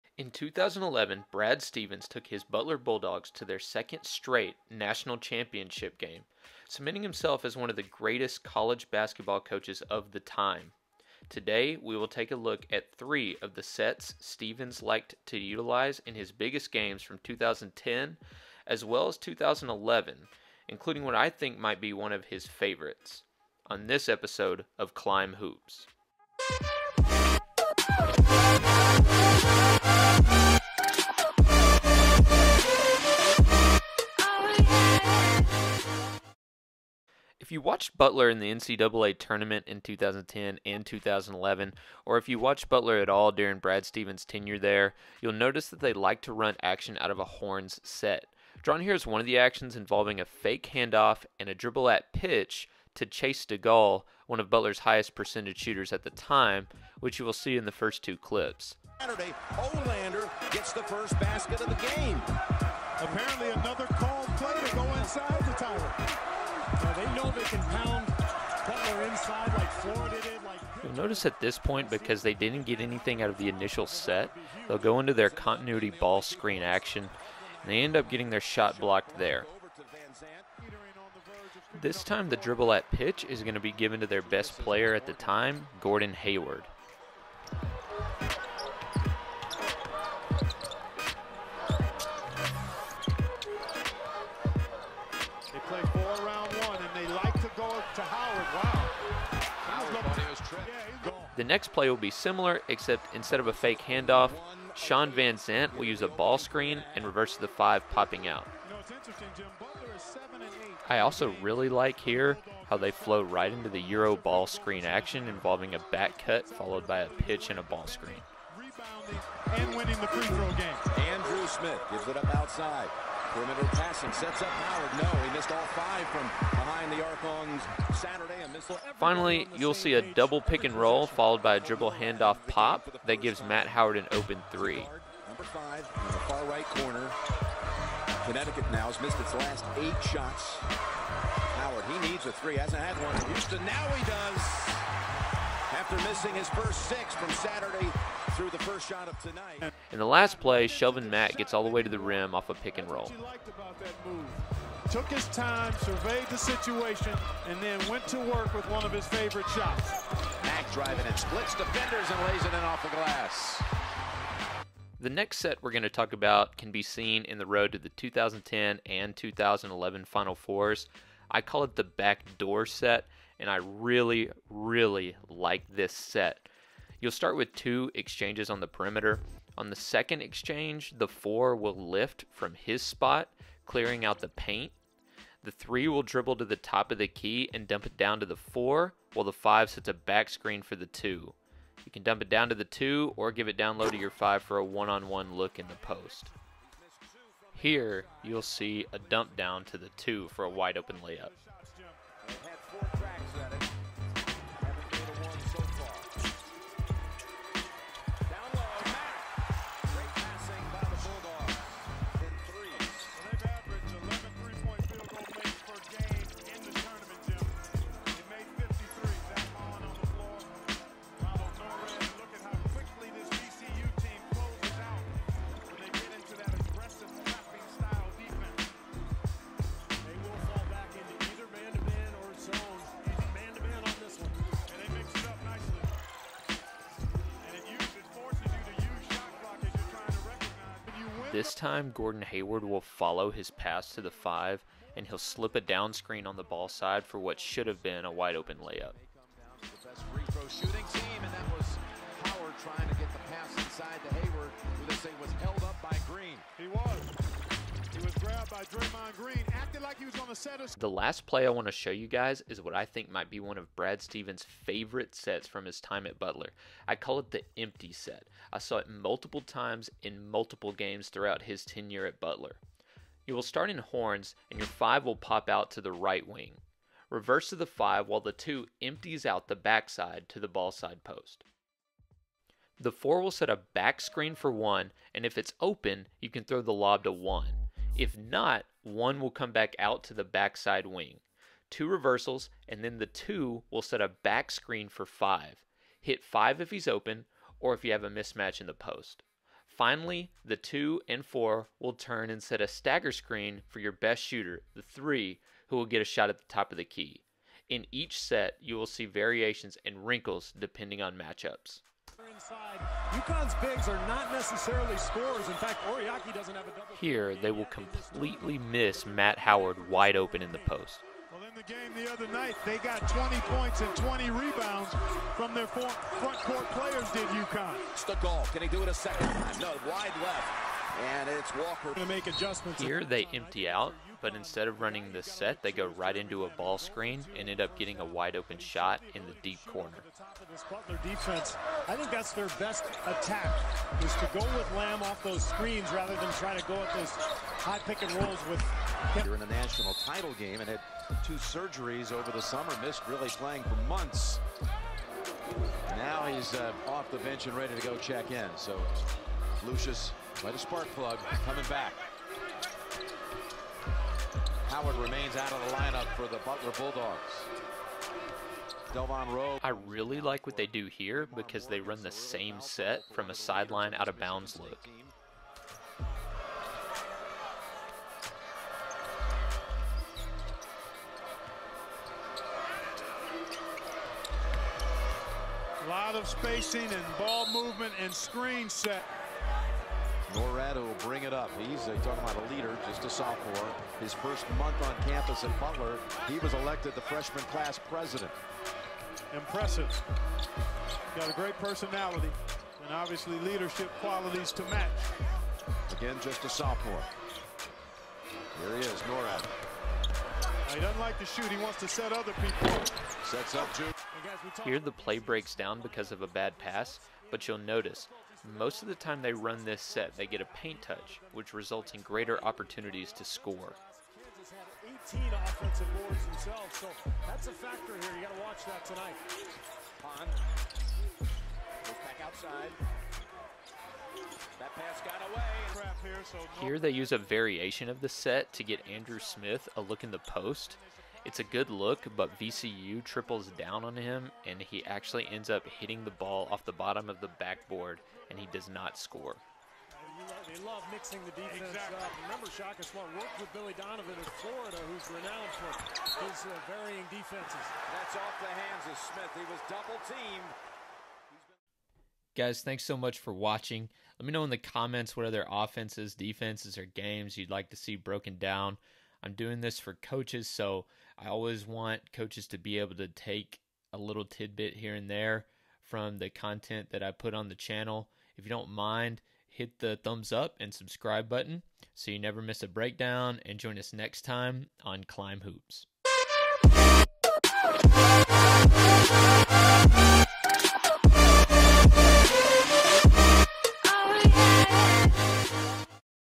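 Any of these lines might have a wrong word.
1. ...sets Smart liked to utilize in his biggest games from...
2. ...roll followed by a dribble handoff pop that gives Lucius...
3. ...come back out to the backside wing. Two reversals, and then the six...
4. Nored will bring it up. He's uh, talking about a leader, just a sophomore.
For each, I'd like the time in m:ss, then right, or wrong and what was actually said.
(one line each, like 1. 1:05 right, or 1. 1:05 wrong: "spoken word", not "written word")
1. 0:13 wrong: "Stevens", not "Smart"
2. 2:10 wrong: "Matt", not "Lucius"
3. 4:49 wrong: "two", not "six"
4. 6:30 right.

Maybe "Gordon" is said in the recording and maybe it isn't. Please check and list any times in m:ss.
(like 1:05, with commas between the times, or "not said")
1:25, 4:01.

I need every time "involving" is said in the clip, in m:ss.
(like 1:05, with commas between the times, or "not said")
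0:49, 1:55.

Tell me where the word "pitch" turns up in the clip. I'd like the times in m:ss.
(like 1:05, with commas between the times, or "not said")
0:52, 1:22, 1:57.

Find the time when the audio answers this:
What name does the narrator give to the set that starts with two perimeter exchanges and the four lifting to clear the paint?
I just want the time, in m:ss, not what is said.
2:51.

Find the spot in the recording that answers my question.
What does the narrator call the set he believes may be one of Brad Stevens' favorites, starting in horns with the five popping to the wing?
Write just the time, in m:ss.
4:27.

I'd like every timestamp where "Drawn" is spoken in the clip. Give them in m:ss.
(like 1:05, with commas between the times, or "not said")
0:48.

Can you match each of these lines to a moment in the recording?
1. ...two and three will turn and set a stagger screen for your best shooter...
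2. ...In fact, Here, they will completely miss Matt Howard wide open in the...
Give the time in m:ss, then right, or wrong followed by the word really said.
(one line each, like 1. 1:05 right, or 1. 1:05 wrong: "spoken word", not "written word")
1. 5:00 wrong: "four", not "three"
2. 5:14 right.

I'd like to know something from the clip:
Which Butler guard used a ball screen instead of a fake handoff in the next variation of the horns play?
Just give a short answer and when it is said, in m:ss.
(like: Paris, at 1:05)
Shawn Vanzant, at 1:44.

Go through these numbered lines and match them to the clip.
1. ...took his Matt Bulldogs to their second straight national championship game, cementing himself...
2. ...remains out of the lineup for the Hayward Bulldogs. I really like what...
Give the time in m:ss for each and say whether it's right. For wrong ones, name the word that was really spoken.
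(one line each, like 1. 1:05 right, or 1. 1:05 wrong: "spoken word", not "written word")
1. 0:02 wrong: "Butler", not "Matt"
2. 6:04 wrong: "Butler", not "Hayward".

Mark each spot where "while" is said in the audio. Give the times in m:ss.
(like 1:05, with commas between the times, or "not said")
3:09, 4:38.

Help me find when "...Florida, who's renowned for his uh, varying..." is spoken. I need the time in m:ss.
7:34.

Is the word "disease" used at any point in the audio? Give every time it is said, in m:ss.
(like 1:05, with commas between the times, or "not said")
not said.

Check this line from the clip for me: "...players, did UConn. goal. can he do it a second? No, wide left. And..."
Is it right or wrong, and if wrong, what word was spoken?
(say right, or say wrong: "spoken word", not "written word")
right.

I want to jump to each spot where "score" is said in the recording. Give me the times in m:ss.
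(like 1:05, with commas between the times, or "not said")
7:03, 7:28.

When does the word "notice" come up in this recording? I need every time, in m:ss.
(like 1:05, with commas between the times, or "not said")
0:45, 1:10, 6:57.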